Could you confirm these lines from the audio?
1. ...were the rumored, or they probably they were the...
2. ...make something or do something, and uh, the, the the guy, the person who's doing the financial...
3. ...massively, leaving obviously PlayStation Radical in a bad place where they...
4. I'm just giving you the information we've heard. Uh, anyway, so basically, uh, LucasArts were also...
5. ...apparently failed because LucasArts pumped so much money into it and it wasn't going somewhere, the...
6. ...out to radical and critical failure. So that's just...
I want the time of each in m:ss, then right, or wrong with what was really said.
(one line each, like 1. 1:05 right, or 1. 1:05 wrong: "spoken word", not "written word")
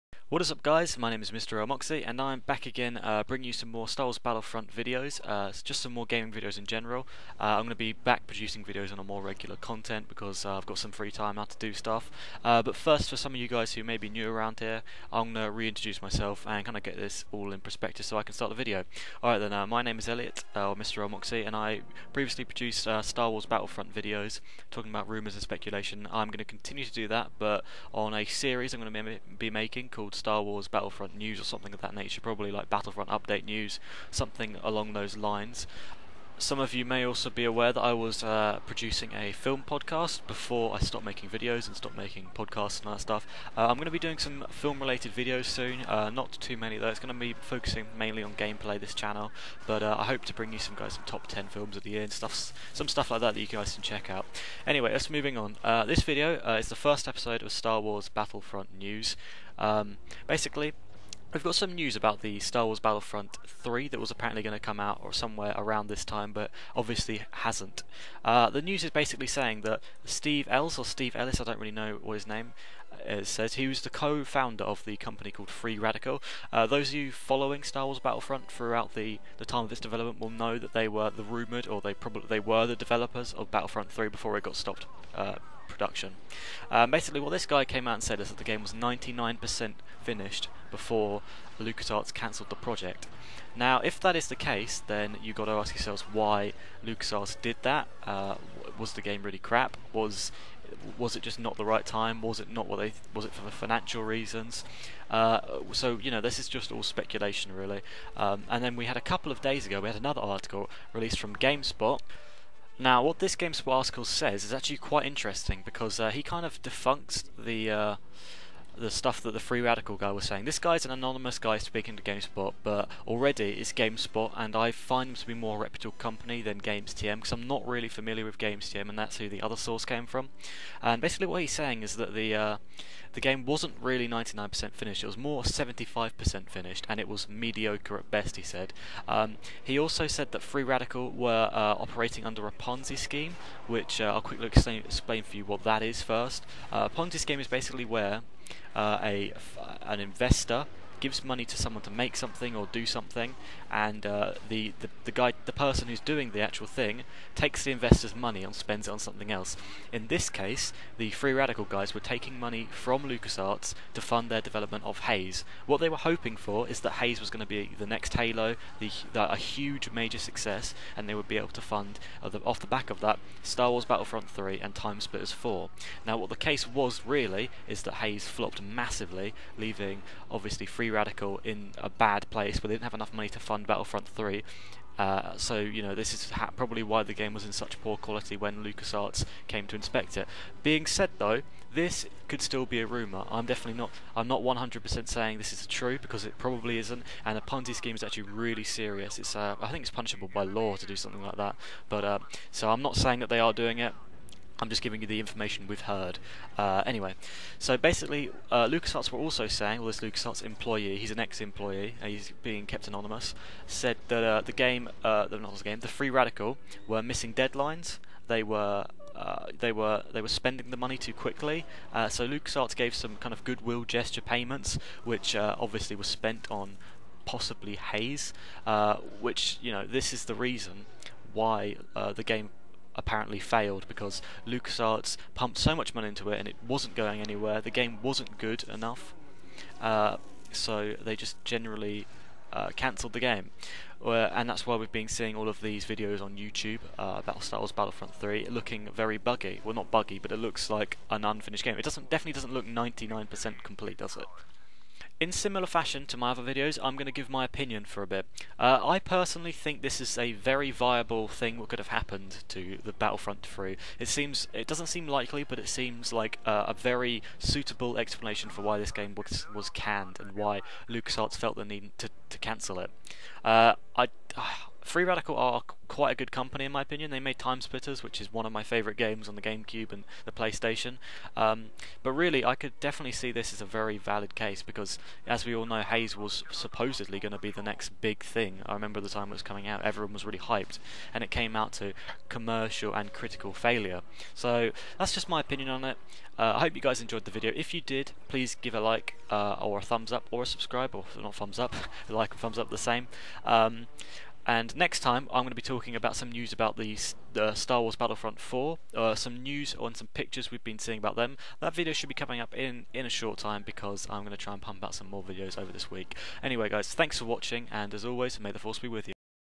1. 1:20 right
2. 2:31 wrong: "actual", not "financial"
3. 2:58 wrong: "Free", not "PlayStation"
4. 3:24 right
5. 3:52 wrong: "anywhere", not "somewhere"
6. 4:51 wrong: "commercial", not "radical".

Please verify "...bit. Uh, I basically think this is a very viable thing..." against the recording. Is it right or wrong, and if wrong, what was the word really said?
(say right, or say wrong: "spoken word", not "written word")
wrong: "personally", not "basically".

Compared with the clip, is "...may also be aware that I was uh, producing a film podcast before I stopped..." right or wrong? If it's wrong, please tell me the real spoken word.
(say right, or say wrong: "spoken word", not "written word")
right.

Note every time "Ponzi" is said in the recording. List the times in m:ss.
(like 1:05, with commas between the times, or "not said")
2:22, 2:26, 3:17.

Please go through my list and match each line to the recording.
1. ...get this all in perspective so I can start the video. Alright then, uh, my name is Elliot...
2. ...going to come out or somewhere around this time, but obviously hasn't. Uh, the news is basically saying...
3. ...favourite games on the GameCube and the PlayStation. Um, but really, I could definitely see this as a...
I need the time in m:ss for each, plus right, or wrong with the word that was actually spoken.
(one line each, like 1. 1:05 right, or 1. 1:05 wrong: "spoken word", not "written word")
1. 0:16 right
2. 1:04 right
3. 4:38 right.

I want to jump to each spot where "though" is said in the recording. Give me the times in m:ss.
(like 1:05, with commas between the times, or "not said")
0:46, 3:11.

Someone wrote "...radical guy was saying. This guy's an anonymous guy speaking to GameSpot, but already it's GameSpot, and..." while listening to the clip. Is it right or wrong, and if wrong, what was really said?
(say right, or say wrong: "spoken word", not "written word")
right.